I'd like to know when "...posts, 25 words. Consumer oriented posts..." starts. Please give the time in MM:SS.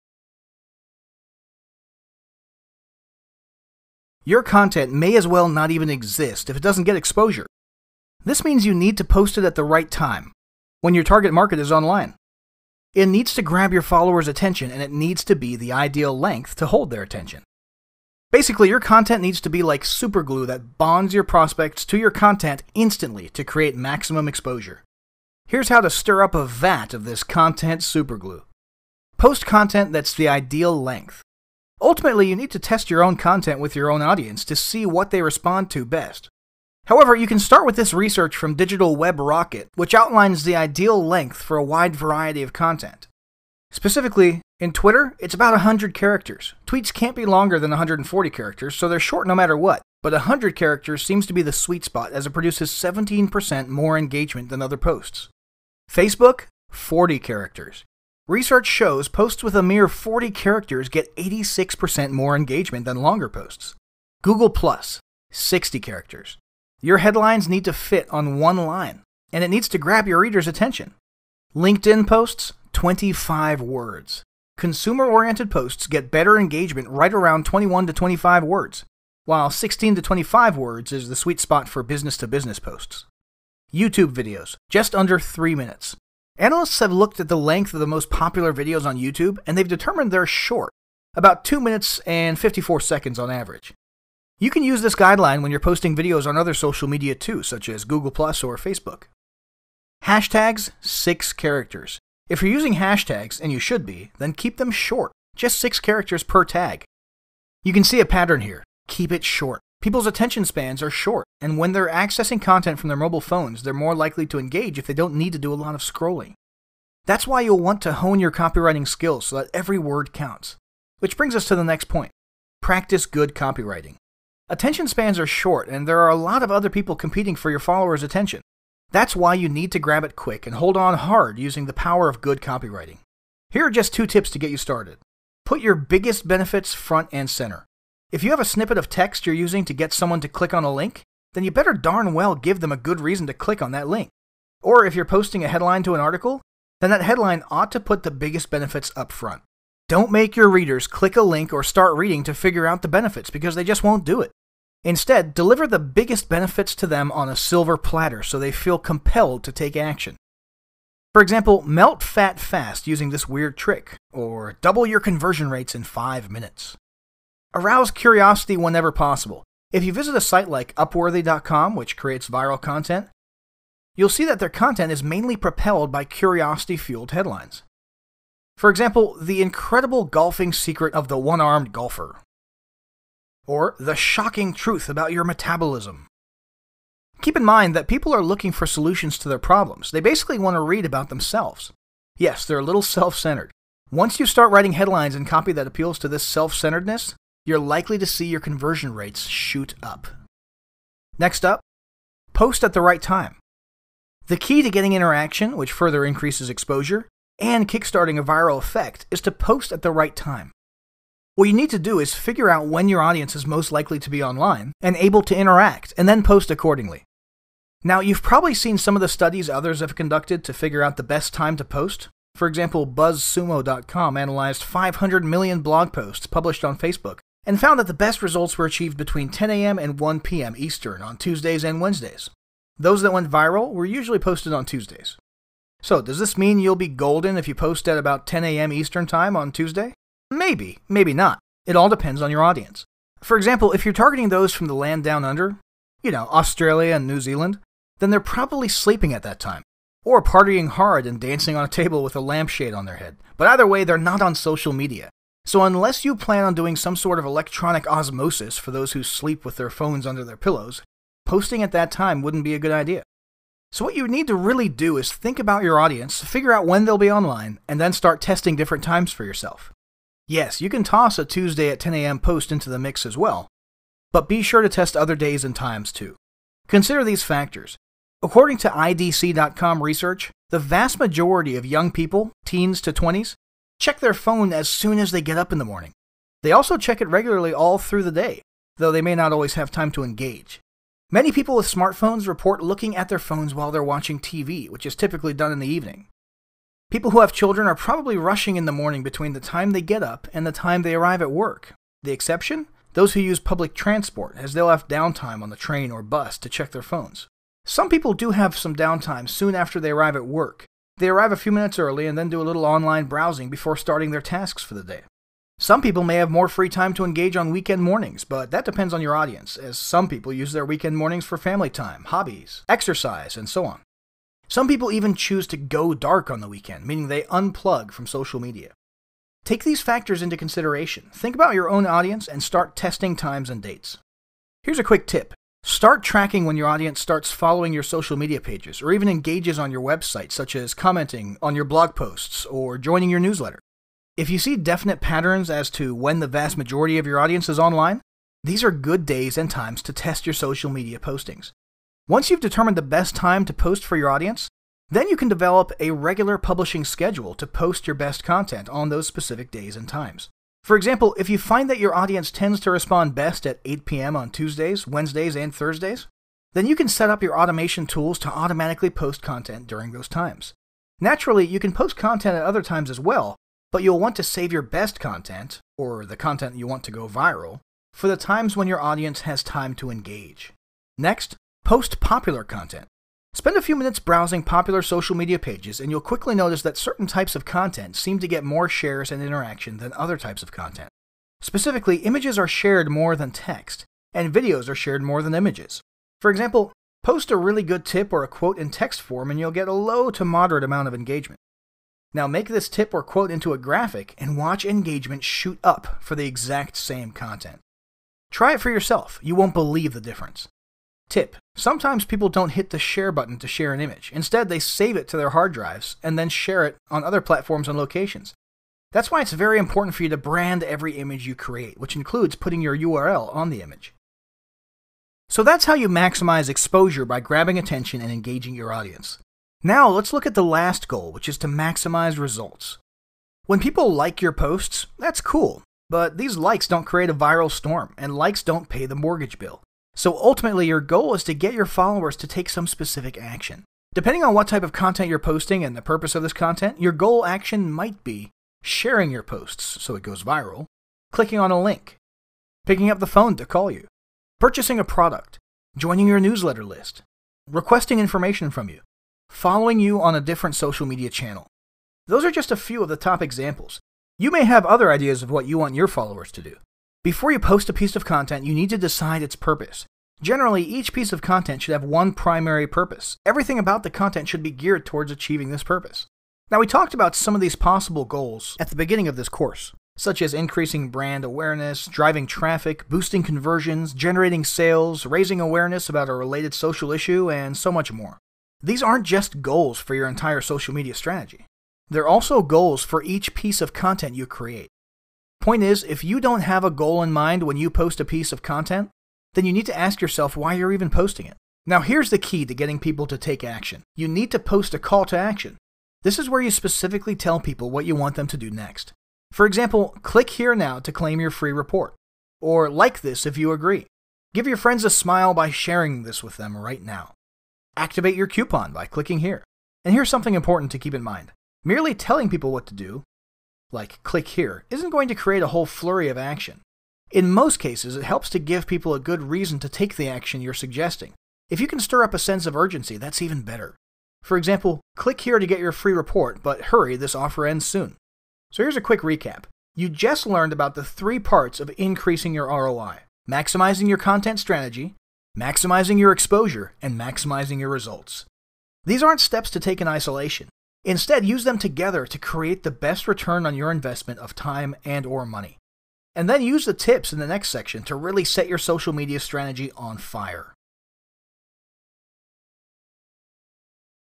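01:12.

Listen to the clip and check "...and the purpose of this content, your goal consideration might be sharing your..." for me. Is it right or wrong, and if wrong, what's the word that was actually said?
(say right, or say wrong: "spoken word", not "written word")
wrong: "action", not "consideration".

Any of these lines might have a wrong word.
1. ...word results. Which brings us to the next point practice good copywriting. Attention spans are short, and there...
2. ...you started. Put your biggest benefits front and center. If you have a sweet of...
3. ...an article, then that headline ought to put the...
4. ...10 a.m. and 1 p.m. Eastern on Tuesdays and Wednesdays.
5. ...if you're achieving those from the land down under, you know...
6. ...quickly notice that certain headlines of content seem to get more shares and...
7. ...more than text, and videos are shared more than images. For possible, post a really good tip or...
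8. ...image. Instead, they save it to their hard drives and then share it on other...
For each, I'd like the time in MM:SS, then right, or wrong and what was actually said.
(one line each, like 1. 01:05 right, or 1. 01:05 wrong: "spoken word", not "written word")
1. 01:59 wrong: "counts", not "results"
2. 02:14 wrong: "snippet", not "sweet"
3. 02:25 right
4. 03:49 right
5. 04:03 wrong: "targeting", not "achieving"
6. 06:26 wrong: "types", not "headlines"
7. 06:32 wrong: "example", not "possible"
8. 06:53 right.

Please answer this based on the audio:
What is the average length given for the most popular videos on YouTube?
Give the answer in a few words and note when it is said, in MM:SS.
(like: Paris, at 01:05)
2 minutes and 54 seconds, at 01:31.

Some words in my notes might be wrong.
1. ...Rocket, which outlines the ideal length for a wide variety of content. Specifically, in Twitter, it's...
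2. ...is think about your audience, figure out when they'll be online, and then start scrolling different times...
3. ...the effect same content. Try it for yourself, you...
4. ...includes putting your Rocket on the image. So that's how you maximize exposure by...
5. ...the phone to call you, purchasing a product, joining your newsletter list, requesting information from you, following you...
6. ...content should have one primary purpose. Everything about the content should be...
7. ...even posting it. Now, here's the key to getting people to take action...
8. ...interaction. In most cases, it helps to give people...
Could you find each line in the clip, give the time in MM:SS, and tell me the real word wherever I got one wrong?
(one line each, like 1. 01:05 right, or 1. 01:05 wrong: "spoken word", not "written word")
1. 00:39 right
2. 04:24 wrong: "testing", not "scrolling"
3. 06:46 wrong: "exact", not "effect"
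4. 07:01 wrong: "URL", not "Rocket"
5. 07:32 right
6. 07:51 right
7. 08:20 right
8. 08:46 wrong: "action", not "interaction".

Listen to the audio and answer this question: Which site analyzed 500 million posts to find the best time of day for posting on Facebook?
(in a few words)
BuzzSumo.com.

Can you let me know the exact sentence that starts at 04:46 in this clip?
They also check it regularly all through the day, though they may not always have time to engage.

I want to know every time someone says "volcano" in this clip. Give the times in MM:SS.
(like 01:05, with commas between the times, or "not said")
not said.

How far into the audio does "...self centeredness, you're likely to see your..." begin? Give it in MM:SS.
03:16.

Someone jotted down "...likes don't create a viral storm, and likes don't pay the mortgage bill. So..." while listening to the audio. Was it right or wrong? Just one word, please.
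right.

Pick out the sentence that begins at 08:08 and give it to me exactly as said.
These aren't just goals for your entire social media strategy.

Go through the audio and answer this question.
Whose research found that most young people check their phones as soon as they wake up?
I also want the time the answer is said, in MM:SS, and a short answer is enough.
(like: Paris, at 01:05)
IDC.com, at 04:38.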